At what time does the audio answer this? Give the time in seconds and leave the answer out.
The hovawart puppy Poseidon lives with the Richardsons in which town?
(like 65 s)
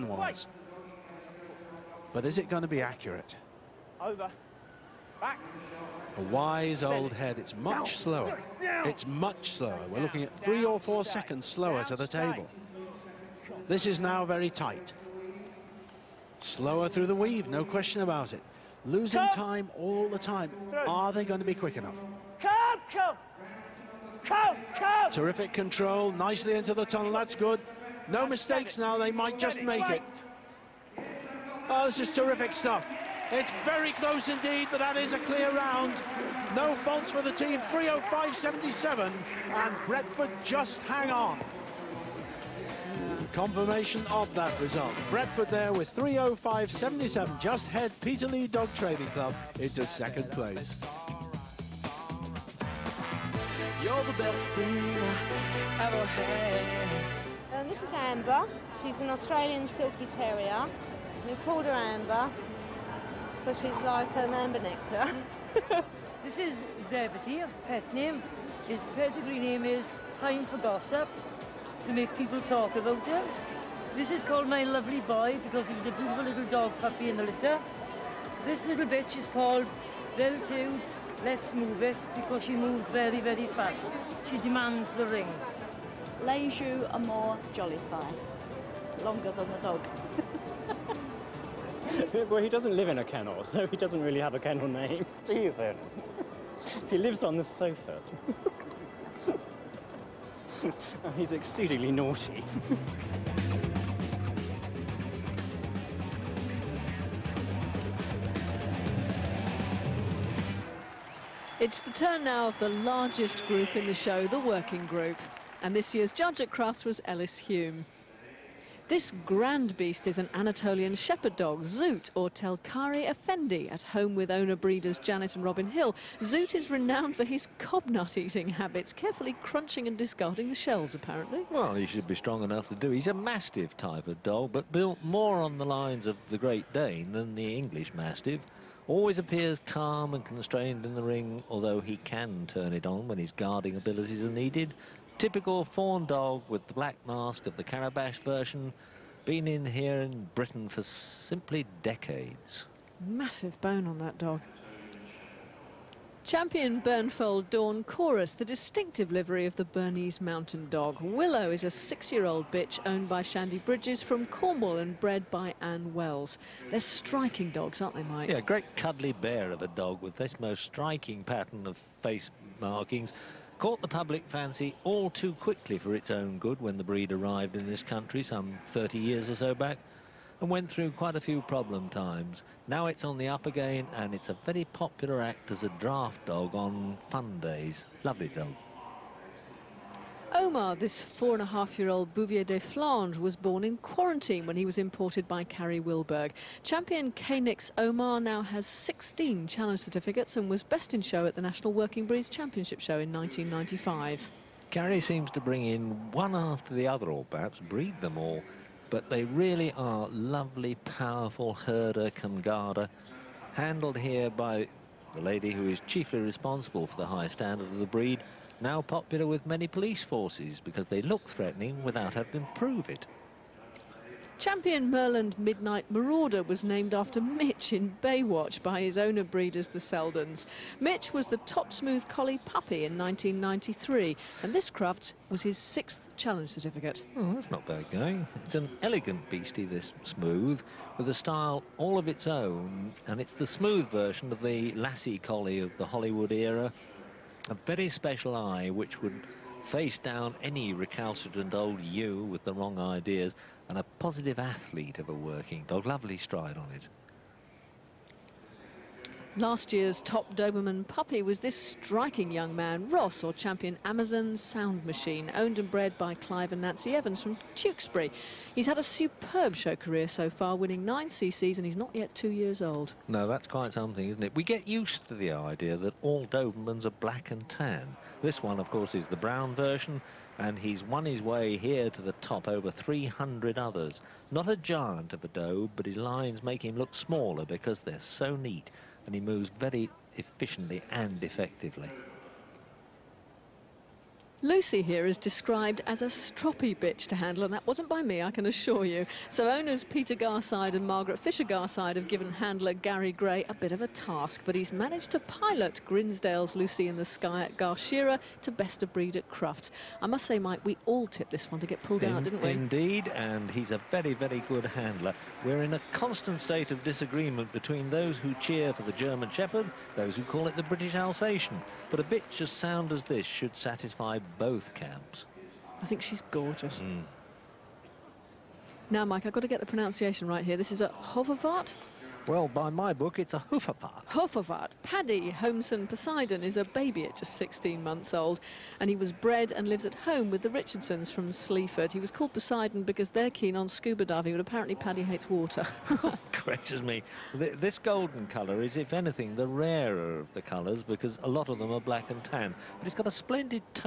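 341 s.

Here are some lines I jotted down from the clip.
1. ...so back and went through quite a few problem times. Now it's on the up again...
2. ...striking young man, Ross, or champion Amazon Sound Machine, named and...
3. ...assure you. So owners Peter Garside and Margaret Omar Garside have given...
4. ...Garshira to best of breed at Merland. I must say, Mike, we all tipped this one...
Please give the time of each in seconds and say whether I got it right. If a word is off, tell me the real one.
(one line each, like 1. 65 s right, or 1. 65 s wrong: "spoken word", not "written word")
1. 179 s right
2. 261 s wrong: "owned", not "named"
3. 298 s wrong: "Fisher", not "Omar"
4. 307 s wrong: "Crufts", not "Merland".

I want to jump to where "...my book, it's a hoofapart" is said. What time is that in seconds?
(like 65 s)
332 s.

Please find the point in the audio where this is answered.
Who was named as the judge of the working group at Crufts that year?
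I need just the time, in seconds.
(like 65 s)
117 s.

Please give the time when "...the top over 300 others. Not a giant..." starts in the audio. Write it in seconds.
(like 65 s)
282 s.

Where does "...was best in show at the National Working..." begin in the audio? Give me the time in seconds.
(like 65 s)
200 s.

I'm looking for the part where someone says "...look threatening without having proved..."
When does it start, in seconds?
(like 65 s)
221 s.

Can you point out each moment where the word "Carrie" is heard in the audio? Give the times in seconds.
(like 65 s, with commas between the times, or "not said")
195 s, 204 s.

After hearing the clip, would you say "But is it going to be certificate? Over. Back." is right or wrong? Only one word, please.
wrong.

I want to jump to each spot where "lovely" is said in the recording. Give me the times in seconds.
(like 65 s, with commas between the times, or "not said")
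74 s, 188 s, 210 s, 255 s.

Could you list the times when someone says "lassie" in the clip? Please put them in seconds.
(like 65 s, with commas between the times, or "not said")
244 s.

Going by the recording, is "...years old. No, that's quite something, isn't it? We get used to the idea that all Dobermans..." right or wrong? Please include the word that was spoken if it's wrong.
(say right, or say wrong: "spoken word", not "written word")
right.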